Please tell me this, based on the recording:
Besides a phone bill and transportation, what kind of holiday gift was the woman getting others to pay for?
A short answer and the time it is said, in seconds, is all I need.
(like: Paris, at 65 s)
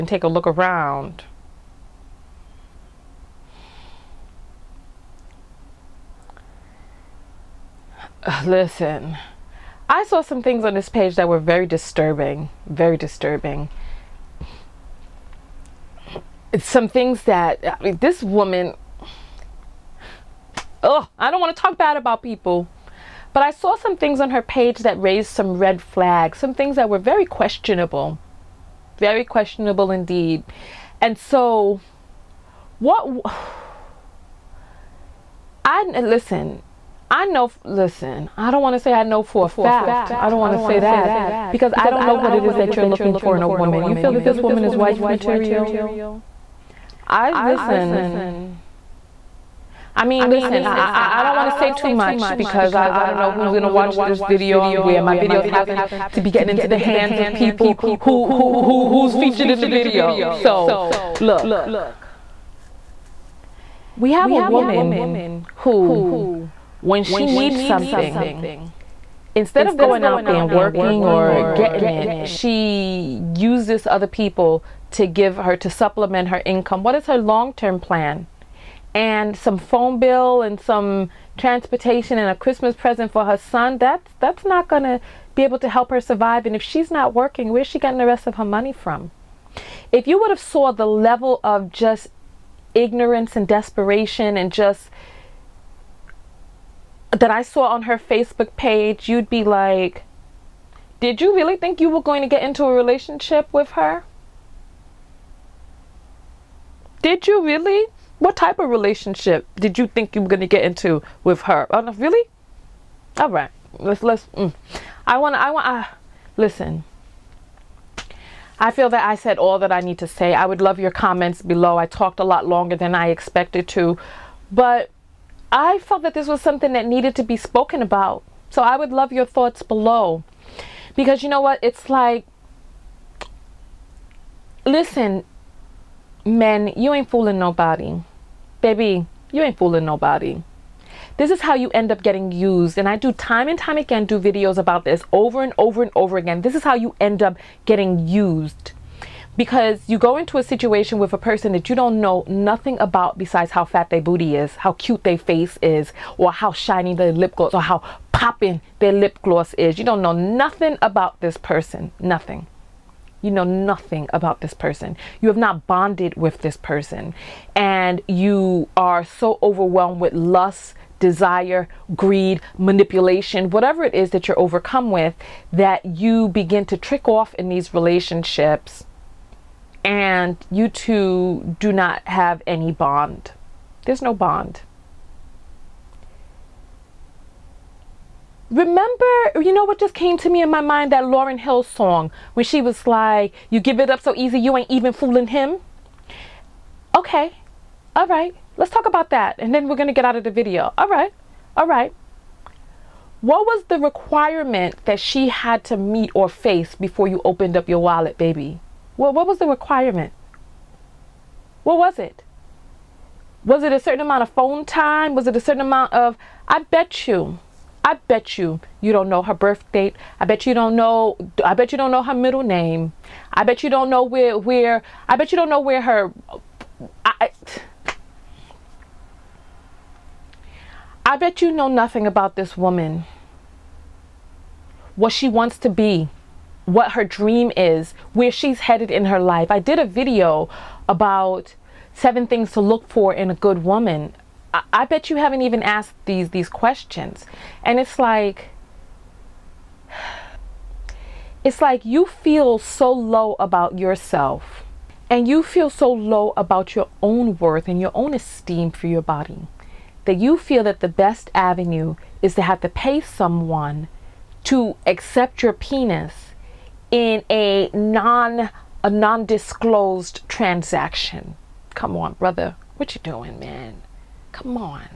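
Christmas present, at 82 s.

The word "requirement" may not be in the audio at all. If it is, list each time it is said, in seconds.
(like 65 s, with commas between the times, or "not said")
203 s, 209 s.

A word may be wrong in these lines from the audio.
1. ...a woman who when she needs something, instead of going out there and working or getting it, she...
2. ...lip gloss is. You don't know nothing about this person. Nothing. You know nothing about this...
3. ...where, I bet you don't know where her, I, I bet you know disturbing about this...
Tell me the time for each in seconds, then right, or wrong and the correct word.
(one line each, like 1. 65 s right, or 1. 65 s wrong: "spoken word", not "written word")
1. 64 s right
2. 158 s right
3. 224 s wrong: "nothing", not "disturbing".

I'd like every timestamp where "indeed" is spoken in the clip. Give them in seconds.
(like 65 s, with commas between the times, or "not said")
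29 s.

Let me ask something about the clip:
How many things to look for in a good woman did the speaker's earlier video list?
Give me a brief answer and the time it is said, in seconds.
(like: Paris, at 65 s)
7, at 241 s.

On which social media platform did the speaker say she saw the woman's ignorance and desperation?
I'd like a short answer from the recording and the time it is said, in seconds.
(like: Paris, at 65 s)
Facebook, at 97 s.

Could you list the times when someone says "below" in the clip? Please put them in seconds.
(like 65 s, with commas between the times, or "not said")
121 s, 129 s.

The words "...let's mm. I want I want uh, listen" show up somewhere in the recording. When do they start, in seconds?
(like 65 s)
114 s.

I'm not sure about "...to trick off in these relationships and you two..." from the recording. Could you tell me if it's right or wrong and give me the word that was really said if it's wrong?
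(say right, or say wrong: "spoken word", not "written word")
right.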